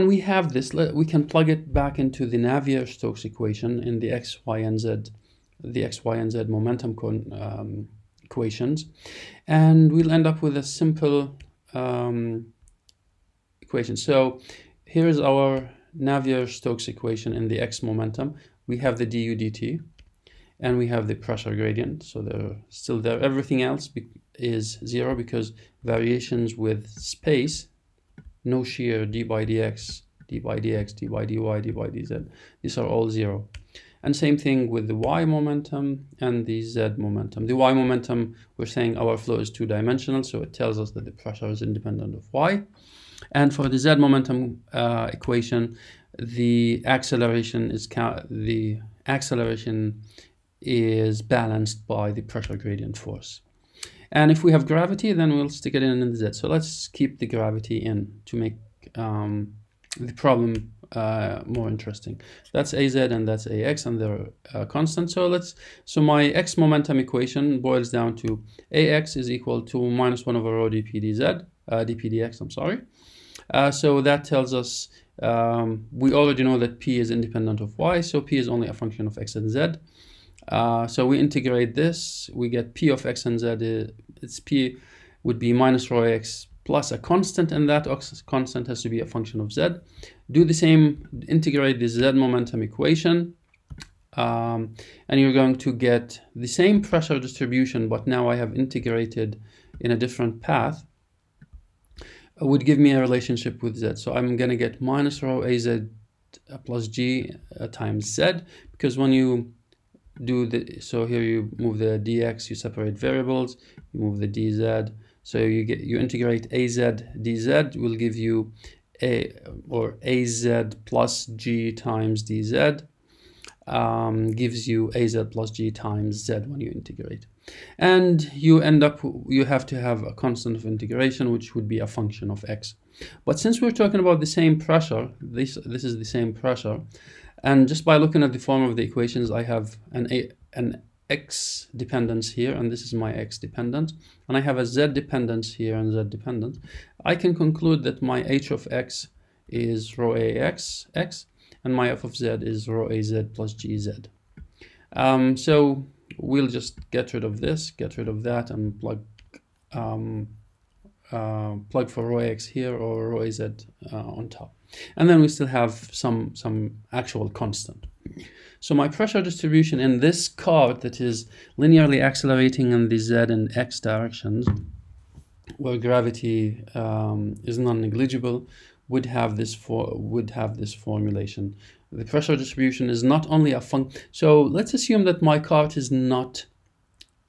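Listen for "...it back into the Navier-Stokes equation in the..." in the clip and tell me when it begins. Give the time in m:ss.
0:01.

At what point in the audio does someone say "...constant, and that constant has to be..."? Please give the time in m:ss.
1:26.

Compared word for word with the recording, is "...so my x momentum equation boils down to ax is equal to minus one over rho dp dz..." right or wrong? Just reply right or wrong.
right.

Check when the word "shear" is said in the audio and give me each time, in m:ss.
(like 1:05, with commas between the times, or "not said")
0:28.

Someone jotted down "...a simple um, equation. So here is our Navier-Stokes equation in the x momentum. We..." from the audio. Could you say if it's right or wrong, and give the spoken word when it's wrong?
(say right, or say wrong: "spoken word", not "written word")
right.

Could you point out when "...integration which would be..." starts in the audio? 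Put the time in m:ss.
2:10.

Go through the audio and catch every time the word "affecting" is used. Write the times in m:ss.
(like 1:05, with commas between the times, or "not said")
not said.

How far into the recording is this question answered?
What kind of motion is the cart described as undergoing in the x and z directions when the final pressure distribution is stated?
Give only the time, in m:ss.
2:51.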